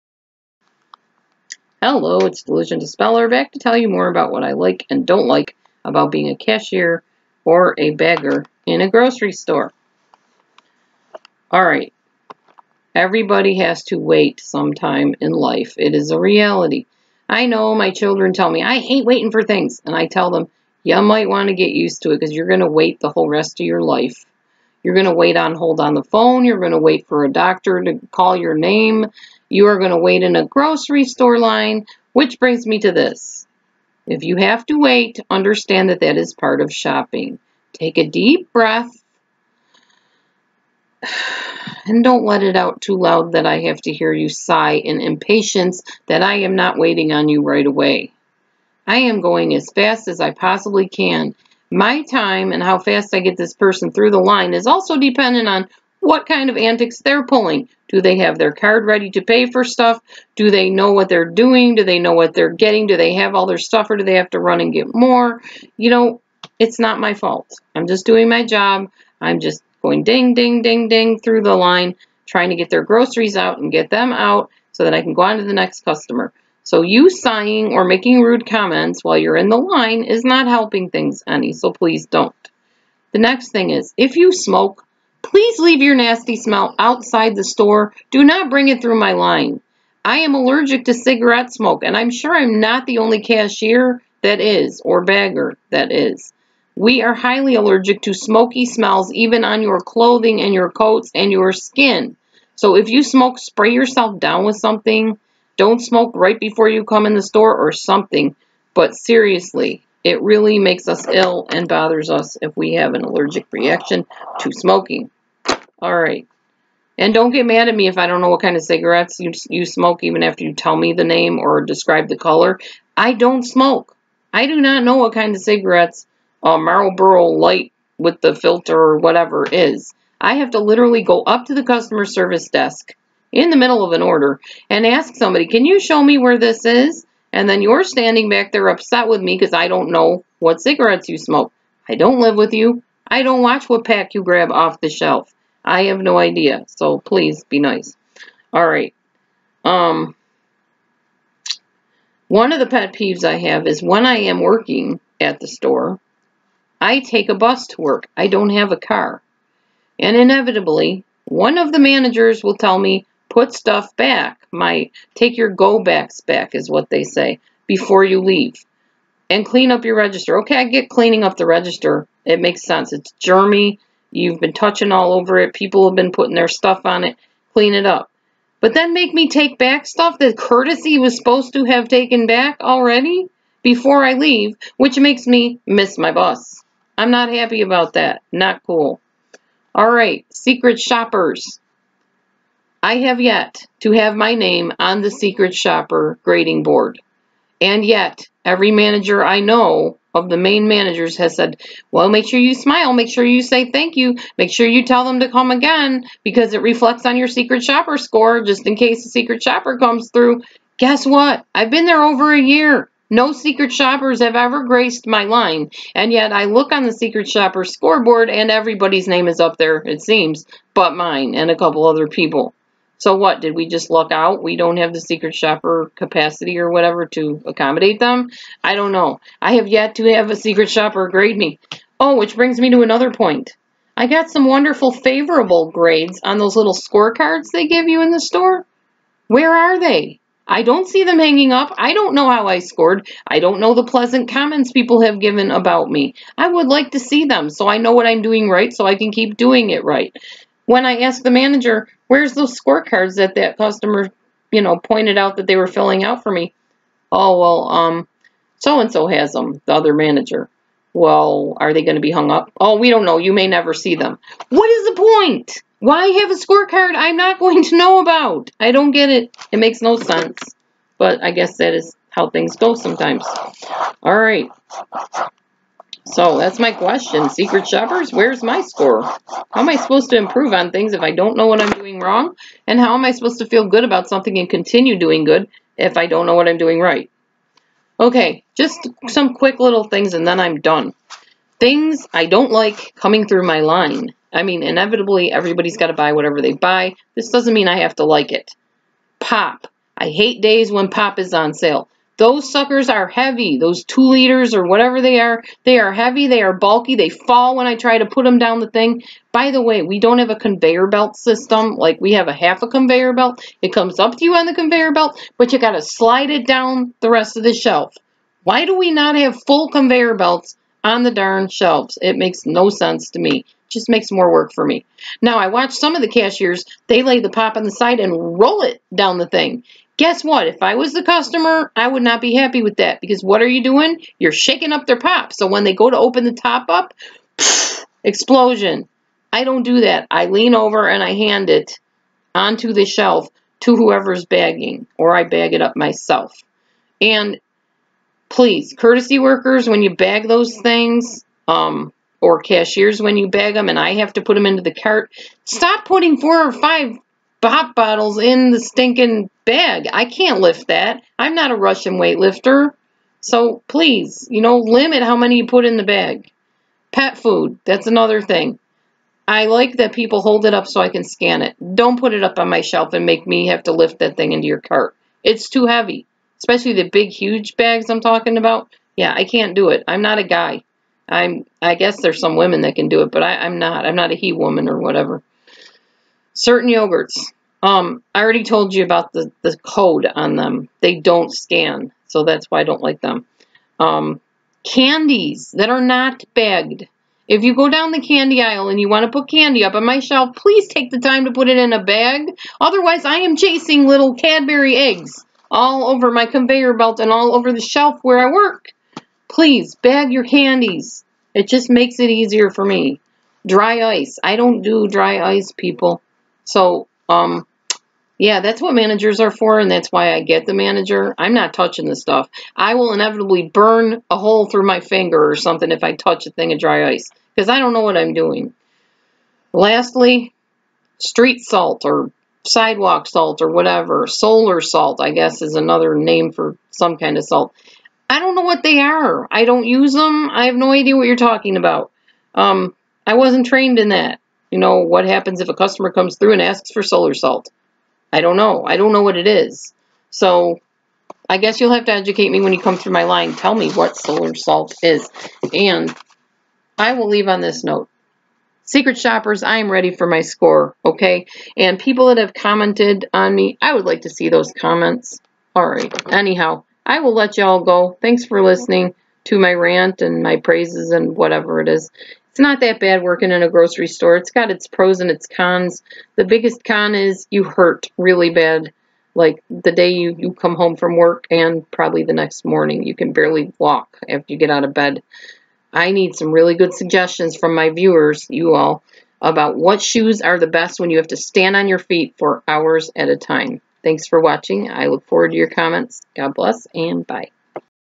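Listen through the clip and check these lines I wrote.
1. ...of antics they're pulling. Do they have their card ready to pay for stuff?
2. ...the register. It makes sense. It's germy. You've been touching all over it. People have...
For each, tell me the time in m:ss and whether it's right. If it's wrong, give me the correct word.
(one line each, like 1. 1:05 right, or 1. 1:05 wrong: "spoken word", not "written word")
1. 0:56 right
2. 2:51 right.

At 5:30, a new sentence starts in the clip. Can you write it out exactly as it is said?
If I was the customer, I would not be happy with that because what are you doing?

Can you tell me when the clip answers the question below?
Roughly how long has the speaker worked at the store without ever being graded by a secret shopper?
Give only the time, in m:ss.
3:32.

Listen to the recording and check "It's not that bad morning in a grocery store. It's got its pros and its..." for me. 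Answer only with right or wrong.
wrong.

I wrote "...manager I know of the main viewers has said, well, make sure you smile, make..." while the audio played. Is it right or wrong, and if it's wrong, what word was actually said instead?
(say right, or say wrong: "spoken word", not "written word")
wrong: "managers", not "viewers".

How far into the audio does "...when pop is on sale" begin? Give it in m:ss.
5:00.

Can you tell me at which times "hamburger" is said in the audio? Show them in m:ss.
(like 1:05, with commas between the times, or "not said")
not said.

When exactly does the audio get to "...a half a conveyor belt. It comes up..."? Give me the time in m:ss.
5:12.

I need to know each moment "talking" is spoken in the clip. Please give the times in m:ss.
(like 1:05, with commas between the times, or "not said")
6:18, 7:21.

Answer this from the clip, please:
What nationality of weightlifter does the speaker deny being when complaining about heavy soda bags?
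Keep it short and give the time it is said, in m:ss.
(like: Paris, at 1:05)
Russian, at 6:01.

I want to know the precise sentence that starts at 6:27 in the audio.
Um, I already told you about the, the code on them.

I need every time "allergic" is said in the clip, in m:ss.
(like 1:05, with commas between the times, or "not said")
1:30, 1:37, 1:53.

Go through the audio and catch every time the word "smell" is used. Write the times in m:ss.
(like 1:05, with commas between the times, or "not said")
1:26, 1:38.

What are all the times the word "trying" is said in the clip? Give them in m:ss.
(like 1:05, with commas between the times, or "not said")
1:12.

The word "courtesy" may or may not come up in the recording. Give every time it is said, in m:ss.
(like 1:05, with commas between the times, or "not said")
3:00, 5:48.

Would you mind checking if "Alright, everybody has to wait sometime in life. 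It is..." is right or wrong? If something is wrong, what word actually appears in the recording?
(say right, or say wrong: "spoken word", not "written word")
right.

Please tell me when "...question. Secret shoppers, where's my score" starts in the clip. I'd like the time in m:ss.
4:36.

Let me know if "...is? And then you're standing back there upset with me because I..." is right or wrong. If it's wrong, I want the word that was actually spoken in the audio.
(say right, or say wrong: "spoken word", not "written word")
right.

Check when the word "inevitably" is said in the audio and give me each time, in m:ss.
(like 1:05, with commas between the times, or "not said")
2:40, 4:54, 7:02.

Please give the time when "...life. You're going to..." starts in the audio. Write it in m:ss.
0:23.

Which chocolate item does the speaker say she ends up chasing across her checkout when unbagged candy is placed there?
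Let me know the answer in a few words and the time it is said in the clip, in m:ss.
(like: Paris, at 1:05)
Cadbury eggs, at 6:44.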